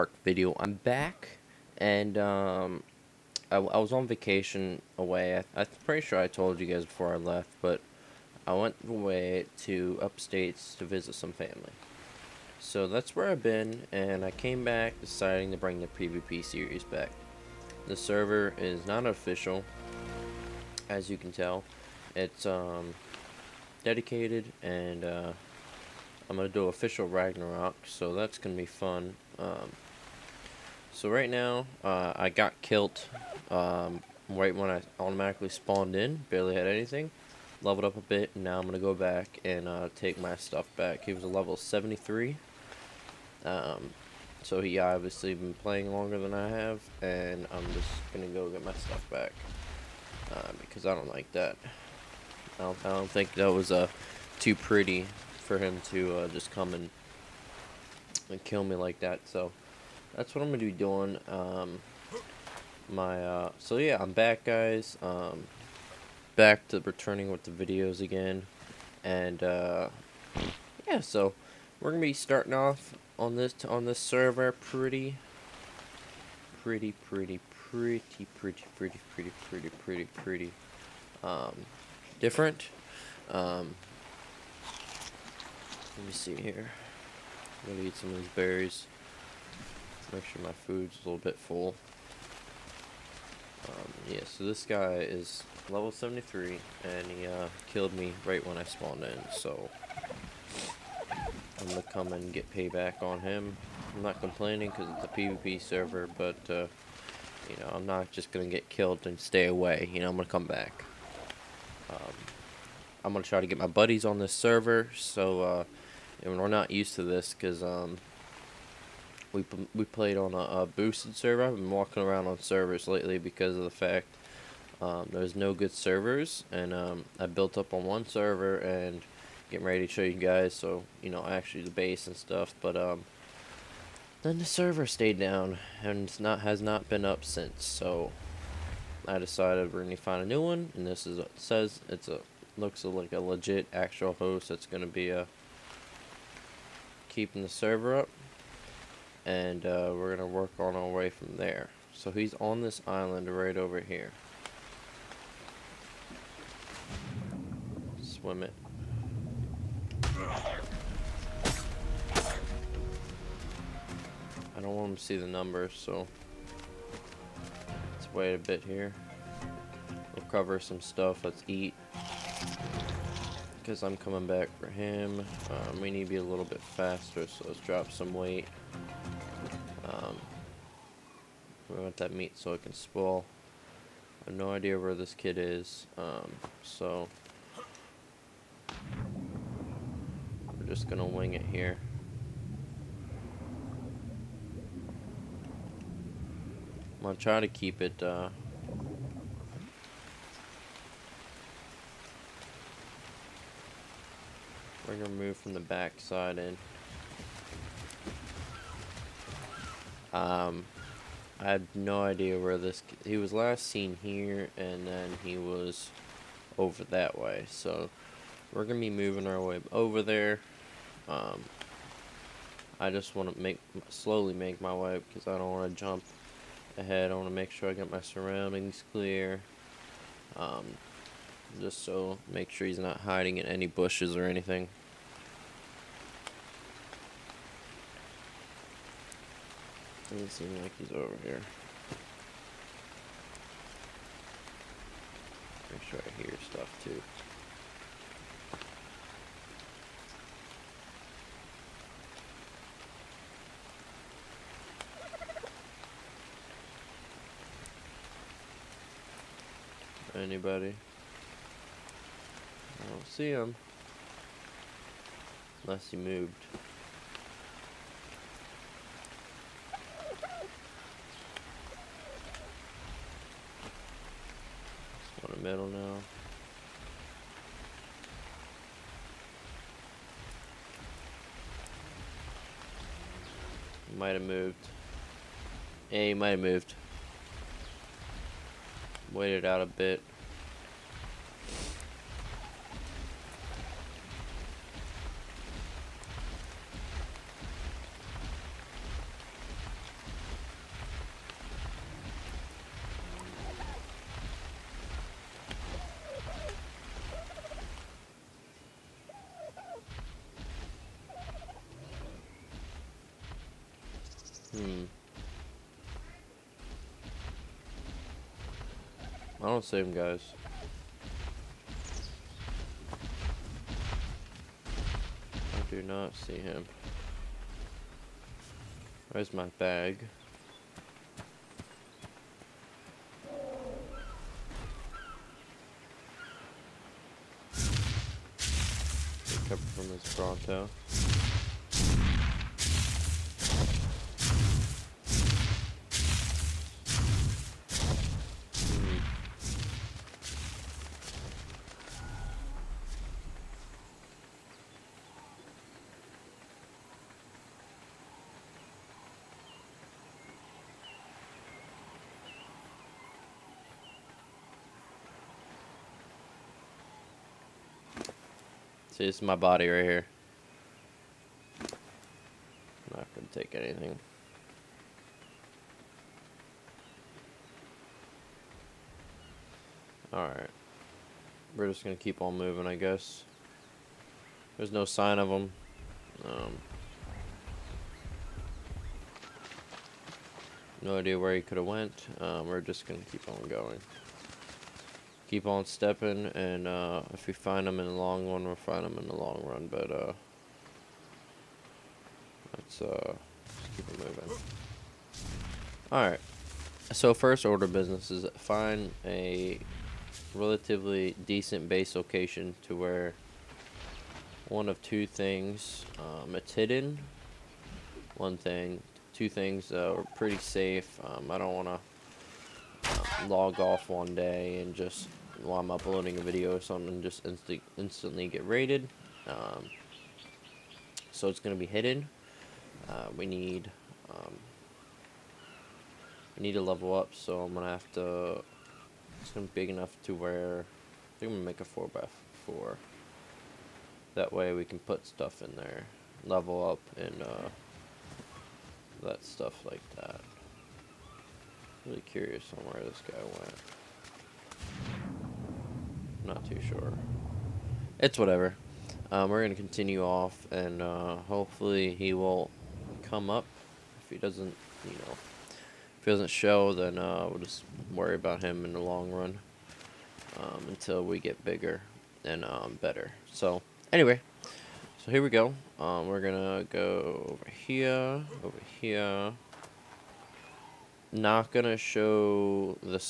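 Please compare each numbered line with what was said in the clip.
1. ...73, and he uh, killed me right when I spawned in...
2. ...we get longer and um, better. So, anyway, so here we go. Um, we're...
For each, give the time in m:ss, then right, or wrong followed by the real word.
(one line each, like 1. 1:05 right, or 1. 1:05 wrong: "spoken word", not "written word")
1. 1:35 right
2. 7:51 wrong: "bigger", not "longer".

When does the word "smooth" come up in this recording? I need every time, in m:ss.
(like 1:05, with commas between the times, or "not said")
not said.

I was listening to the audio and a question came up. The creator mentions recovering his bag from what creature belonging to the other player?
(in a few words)
Bronto.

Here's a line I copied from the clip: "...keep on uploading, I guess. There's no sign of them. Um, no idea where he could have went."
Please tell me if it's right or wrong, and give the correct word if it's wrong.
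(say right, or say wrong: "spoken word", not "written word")
wrong: "moving", not "uploading".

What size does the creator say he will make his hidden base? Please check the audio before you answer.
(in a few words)
4 by 4.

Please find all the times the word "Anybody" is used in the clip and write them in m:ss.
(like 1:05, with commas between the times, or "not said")
4:20.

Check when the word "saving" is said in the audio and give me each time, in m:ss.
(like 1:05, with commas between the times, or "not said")
not said.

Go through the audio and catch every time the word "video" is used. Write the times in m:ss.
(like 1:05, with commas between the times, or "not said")
0:00, 1:07, 7:06.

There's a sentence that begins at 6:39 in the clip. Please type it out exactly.
But uh, let's uh, keep it moving.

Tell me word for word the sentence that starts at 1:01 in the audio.
Um, my uh, So yeah, I'm back, guys.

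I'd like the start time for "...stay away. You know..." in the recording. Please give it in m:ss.
1:49.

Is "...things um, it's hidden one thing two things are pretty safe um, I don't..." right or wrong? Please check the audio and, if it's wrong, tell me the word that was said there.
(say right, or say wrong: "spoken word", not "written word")
right.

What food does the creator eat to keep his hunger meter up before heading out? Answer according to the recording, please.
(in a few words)
Berries.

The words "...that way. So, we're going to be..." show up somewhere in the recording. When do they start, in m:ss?
3:36.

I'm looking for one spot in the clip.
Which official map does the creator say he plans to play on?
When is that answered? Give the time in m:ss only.
0:27.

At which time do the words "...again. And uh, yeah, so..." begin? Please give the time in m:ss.
1:07.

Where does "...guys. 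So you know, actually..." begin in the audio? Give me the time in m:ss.
2:10.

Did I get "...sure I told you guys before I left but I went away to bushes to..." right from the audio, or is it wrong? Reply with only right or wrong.
wrong.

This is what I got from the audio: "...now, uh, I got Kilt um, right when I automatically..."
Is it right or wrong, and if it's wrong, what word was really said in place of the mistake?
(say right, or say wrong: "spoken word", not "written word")
right.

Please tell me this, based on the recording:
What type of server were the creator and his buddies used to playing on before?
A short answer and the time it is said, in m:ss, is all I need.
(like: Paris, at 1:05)
Boosted server, at 2:00.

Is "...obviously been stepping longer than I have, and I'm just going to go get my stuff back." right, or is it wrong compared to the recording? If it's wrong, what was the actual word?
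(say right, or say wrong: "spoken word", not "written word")
wrong: "playing", not "stepping".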